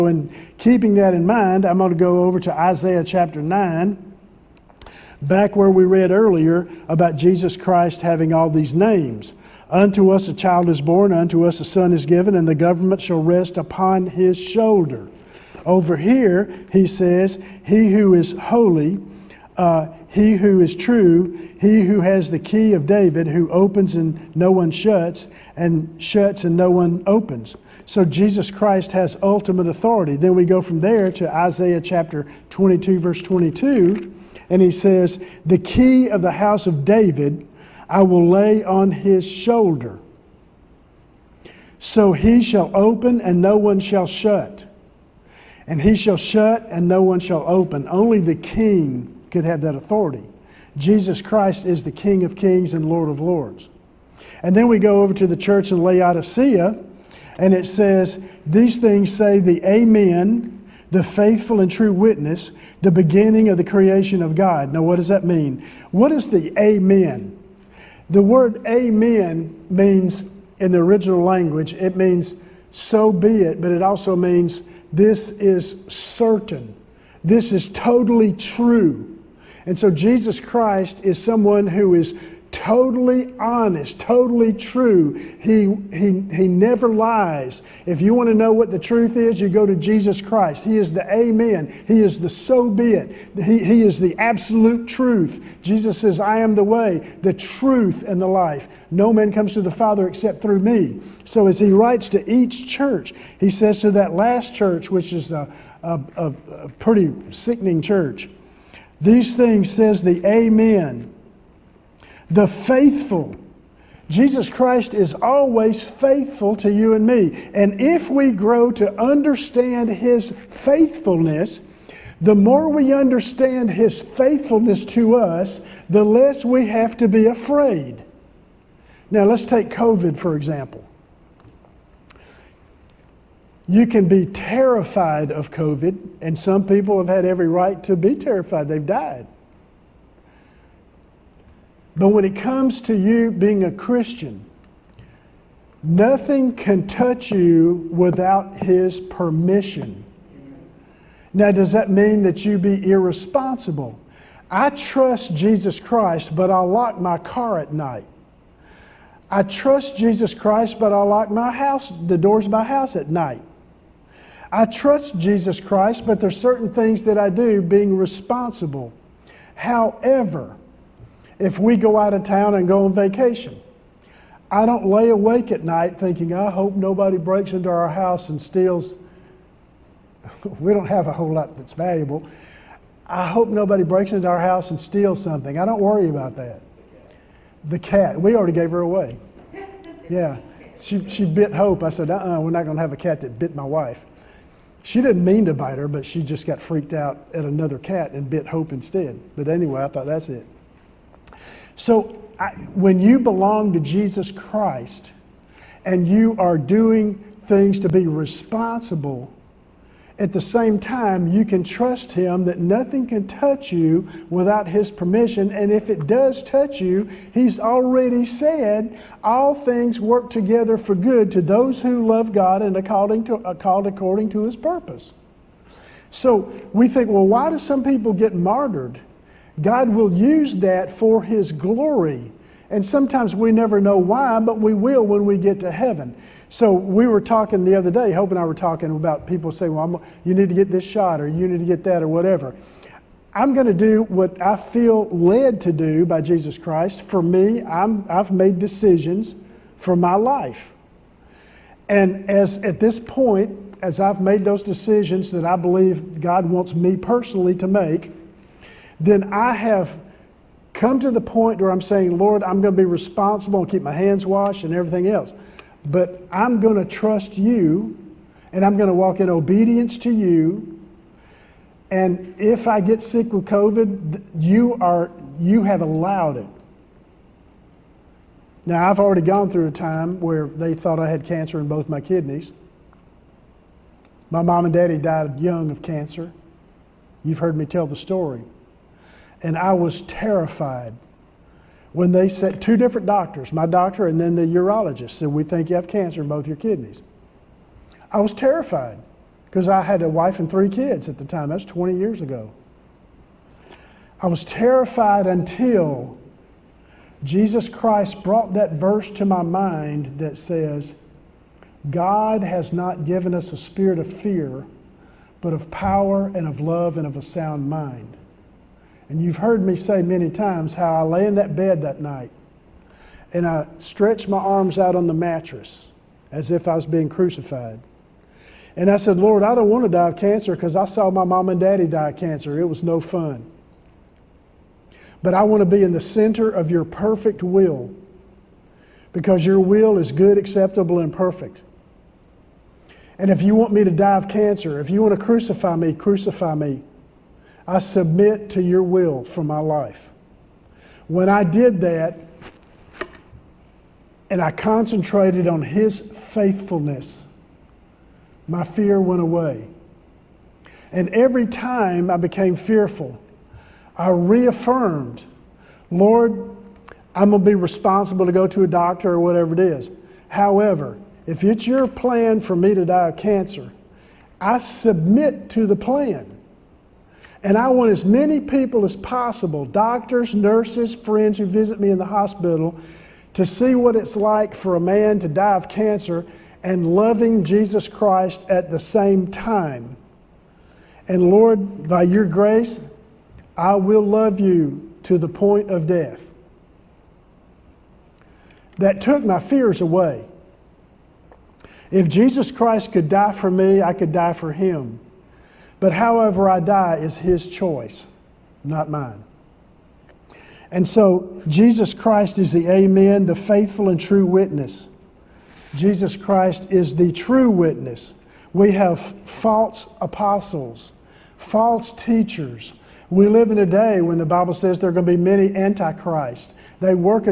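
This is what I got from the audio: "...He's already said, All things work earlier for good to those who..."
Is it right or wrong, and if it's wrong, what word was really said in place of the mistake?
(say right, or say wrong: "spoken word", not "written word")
wrong: "together", not "earlier".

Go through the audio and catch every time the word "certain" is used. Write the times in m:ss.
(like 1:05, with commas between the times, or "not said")
1:15, 2:46.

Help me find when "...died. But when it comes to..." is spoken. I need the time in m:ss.
2:18.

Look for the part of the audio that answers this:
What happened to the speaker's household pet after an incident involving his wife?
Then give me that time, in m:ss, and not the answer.
3:08.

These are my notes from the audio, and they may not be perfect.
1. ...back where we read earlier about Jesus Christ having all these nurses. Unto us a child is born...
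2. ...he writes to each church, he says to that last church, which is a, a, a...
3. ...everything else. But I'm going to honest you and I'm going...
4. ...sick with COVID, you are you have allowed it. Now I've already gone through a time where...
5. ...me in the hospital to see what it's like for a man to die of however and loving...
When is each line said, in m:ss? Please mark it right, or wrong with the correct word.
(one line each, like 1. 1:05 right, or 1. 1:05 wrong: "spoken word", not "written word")
1. 0:05 wrong: "names", not "nurses"
2. 1:41 right
3. 4:24 wrong: "trust", not "honest"
4. 4:33 right
5. 6:21 wrong: "cancer", not "however".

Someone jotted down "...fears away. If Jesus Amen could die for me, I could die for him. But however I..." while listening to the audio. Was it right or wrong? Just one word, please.
wrong.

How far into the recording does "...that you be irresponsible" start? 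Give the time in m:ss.
2:32.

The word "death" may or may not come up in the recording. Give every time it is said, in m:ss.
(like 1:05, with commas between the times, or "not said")
6:35.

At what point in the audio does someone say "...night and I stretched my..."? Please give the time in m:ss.
5:21.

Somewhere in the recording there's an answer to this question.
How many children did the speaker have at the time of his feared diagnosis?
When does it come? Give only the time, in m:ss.
5:00.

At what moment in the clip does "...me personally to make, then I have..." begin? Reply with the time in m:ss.
4:16.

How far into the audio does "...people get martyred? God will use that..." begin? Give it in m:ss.
3:47.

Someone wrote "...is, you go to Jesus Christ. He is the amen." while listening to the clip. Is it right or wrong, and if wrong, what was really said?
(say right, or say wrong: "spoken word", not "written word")
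right.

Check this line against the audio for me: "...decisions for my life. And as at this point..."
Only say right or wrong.
right.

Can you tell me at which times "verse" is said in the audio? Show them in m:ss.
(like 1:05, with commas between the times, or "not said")
0:32, 5:08.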